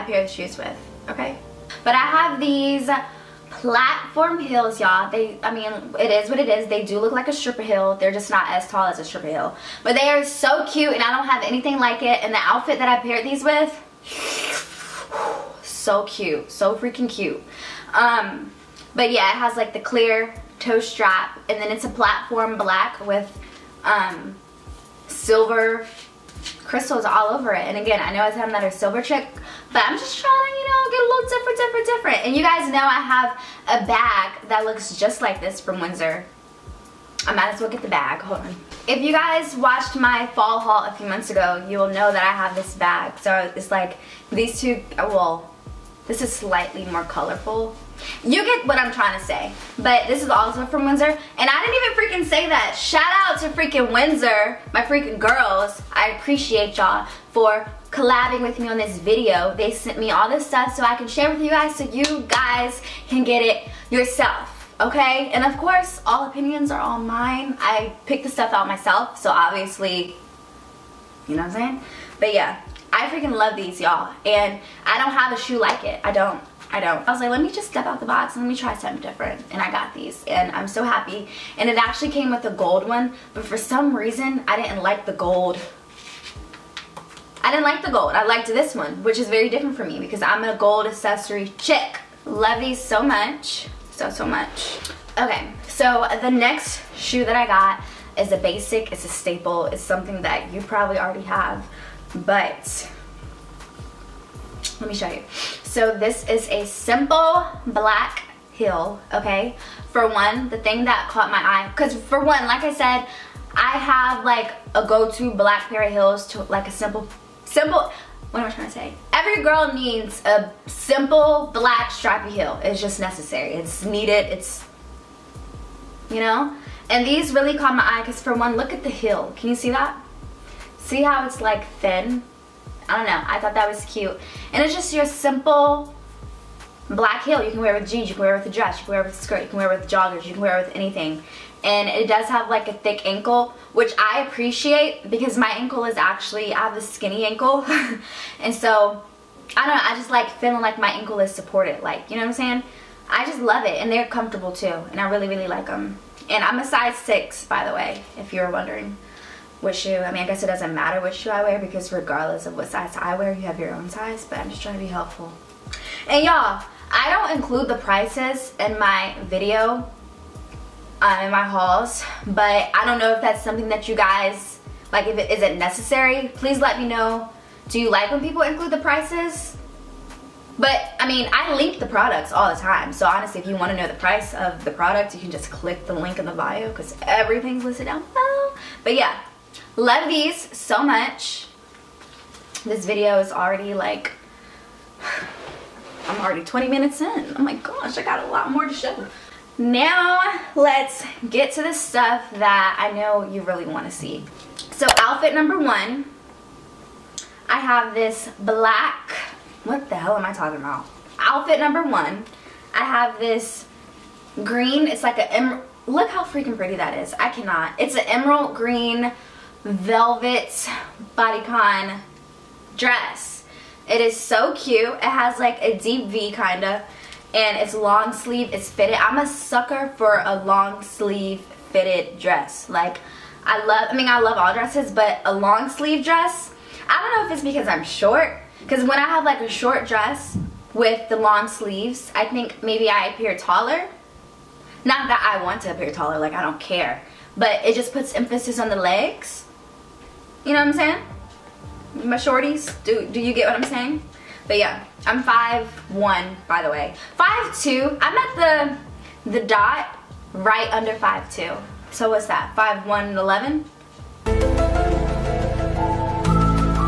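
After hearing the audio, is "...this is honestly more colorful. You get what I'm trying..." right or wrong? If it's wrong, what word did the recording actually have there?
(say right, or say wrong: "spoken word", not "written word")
wrong: "slightly", not "honestly".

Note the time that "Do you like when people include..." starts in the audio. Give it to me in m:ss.
2:57.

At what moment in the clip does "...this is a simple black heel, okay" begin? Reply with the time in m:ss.
1:45.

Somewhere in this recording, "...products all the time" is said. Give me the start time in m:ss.
3:01.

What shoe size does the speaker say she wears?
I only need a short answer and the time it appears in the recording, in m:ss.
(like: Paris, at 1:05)
6, at 2:36.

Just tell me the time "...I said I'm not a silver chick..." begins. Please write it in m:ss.
0:28.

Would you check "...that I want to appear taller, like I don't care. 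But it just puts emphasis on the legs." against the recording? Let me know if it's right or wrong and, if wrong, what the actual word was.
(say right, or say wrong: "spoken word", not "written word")
right.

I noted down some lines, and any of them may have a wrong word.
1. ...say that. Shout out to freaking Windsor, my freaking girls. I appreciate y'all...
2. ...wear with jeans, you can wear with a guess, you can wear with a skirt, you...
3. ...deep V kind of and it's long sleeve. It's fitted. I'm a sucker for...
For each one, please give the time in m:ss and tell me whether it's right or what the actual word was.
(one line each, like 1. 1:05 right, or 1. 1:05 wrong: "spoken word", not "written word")
1. 0:52 right
2. 2:17 wrong: "dress", not "guess"
3. 3:45 right.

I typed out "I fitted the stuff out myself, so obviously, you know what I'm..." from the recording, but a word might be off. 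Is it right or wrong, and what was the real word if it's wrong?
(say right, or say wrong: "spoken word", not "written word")
wrong: "picked", not "fitted".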